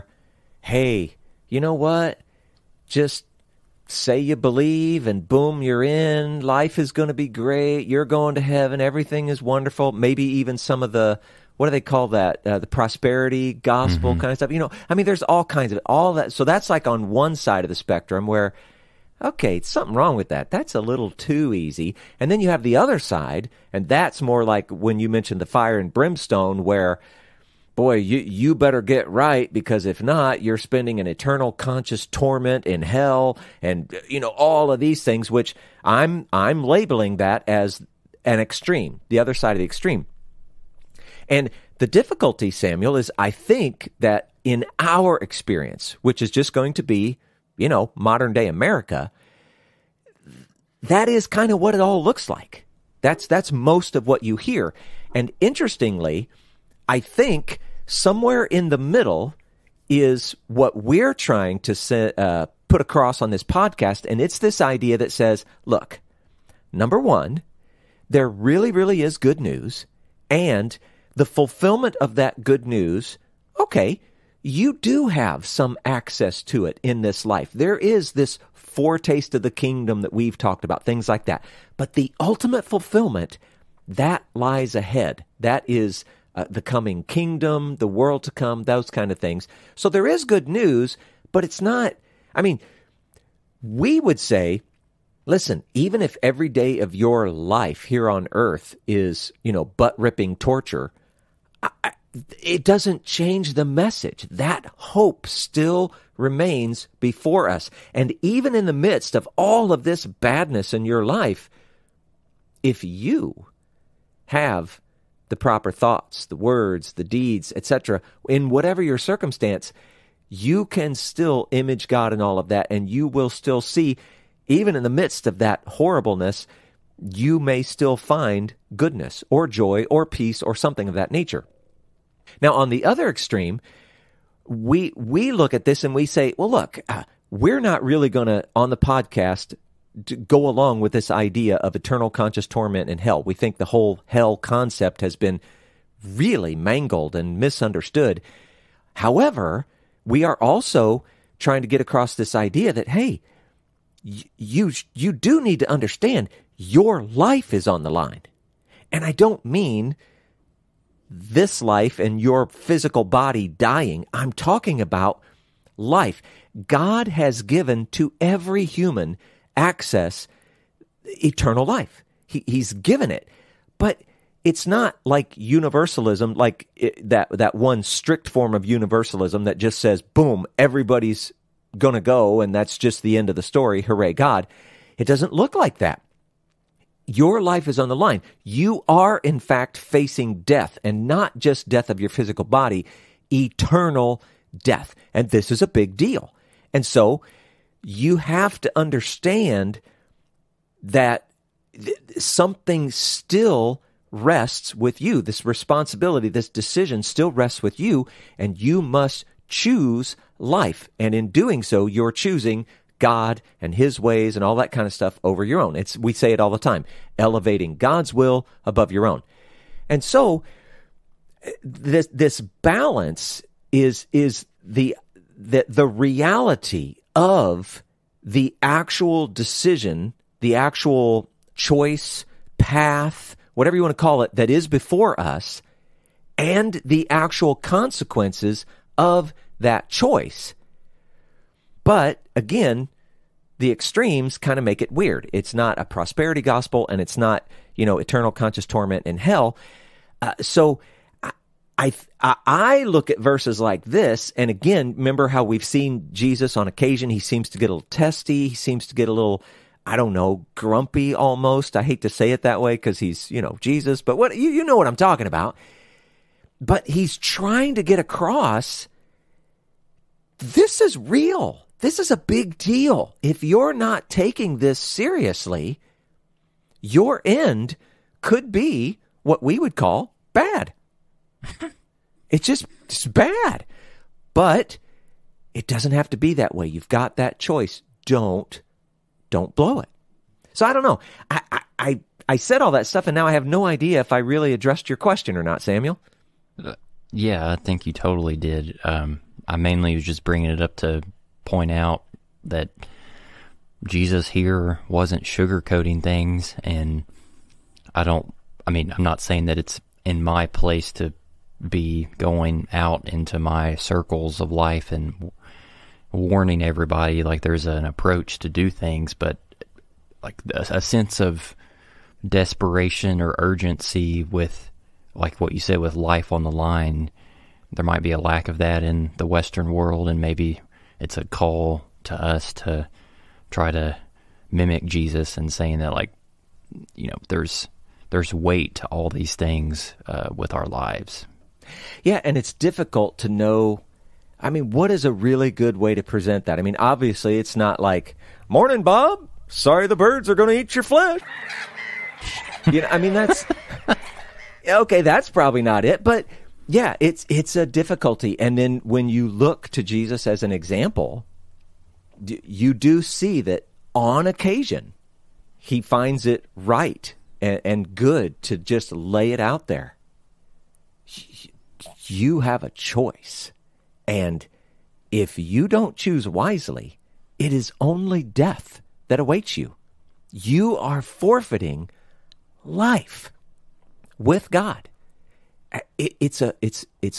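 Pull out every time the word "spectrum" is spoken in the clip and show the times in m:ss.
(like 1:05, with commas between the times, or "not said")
0:17.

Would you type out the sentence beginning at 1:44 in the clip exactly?
That hope still remains before us.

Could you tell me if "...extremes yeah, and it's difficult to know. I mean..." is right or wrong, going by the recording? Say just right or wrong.
wrong.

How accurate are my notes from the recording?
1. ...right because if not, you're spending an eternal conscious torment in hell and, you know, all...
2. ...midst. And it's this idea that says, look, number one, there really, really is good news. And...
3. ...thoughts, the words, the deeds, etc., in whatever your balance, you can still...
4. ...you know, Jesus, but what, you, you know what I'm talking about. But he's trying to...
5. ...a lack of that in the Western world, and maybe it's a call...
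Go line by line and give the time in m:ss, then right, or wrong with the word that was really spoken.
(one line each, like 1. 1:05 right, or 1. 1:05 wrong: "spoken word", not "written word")
1. 0:29 right
2. 1:03 wrong: "podcast", not "midst"
3. 1:55 wrong: "circumstance", not "balance"
4. 4:23 right
5. 5:28 right.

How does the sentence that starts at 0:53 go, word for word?
That's, that's most of what you hear.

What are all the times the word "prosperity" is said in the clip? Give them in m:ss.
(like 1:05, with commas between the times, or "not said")
0:12, 4:05.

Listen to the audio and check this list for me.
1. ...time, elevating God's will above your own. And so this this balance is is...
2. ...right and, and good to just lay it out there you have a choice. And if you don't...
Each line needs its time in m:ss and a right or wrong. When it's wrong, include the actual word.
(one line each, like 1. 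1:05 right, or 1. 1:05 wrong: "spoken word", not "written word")
1. 3:36 right
2. 6:06 right.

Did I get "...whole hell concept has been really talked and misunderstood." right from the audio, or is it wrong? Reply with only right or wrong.
wrong.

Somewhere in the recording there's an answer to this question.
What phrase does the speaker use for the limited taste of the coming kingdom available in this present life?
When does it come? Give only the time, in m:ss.
1:18.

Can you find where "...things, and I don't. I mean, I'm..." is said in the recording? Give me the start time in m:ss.
5:06.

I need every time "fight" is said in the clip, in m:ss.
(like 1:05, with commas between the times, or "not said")
not said.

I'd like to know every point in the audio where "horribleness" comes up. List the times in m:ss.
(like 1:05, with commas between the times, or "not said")
2:05.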